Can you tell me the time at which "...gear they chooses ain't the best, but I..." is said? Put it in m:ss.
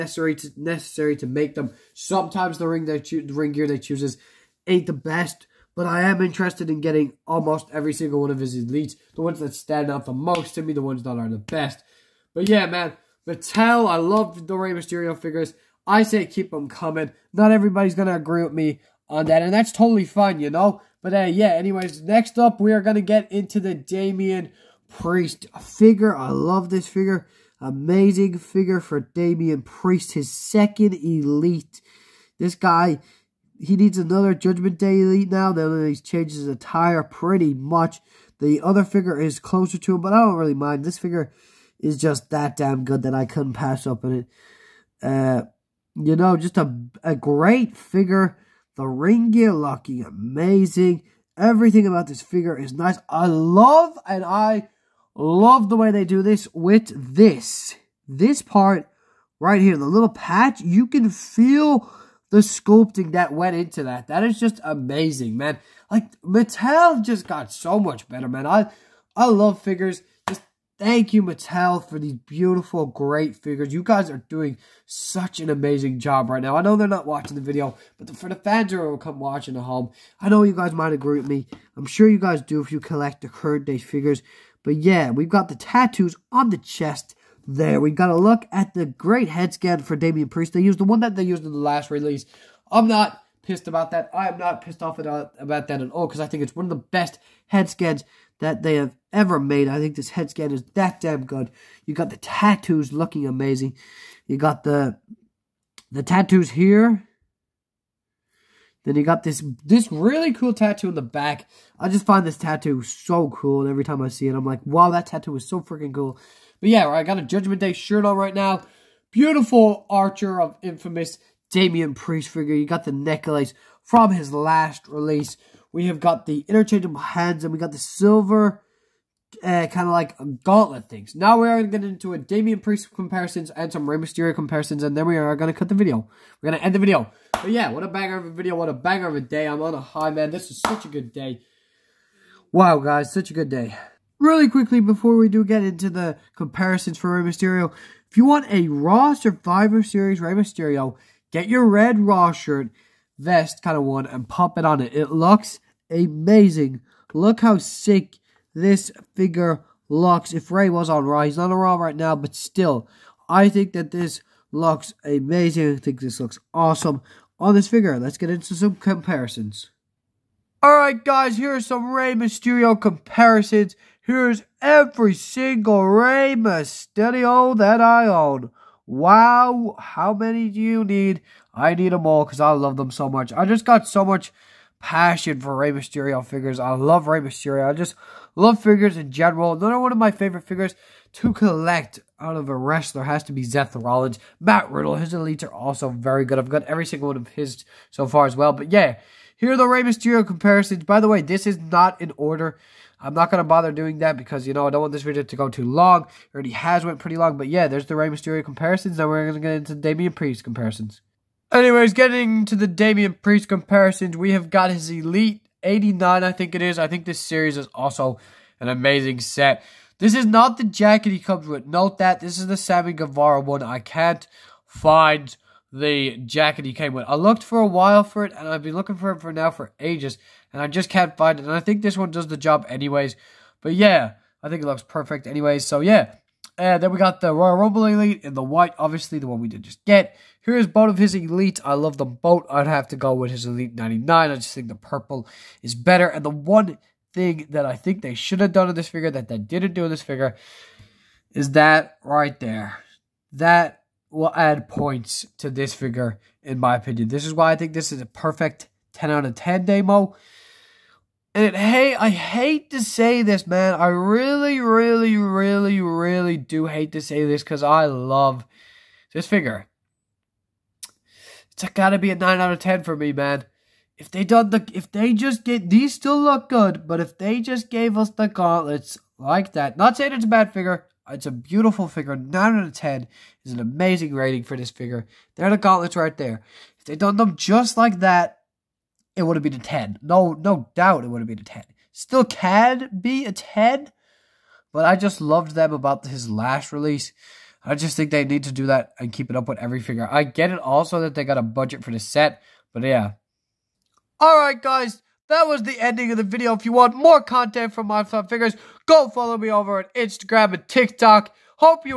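0:03.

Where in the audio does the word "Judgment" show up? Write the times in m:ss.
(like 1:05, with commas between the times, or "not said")
0:34, 1:57.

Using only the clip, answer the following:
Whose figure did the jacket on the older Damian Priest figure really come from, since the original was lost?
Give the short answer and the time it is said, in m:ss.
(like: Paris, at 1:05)
Sammy Guevara, at 3:42.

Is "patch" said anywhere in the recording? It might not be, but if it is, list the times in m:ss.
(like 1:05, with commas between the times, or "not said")
1:00.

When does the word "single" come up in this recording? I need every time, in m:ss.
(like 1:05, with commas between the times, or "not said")
0:07, 2:55, 3:16.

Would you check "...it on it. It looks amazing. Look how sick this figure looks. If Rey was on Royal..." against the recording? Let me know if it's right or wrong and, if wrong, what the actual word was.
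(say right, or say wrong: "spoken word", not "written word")
wrong: "Raw", not "Royal".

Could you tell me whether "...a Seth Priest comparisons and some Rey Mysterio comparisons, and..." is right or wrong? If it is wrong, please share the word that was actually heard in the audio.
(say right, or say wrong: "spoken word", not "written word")
wrong: "Damian", not "Seth".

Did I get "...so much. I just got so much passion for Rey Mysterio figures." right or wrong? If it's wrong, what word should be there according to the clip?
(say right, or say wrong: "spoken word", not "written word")
right.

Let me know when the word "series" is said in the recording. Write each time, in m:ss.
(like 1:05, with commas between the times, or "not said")
2:29, 3:37.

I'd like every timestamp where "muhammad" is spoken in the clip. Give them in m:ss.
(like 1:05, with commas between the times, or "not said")
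not said.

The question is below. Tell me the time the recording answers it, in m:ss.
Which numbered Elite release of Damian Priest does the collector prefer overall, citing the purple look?
4:03.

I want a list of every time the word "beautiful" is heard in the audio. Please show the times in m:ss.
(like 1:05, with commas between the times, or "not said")
1:12, 1:59, 4:41.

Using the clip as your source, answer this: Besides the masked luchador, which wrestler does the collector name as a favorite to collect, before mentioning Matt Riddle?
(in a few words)
Seth Rollins.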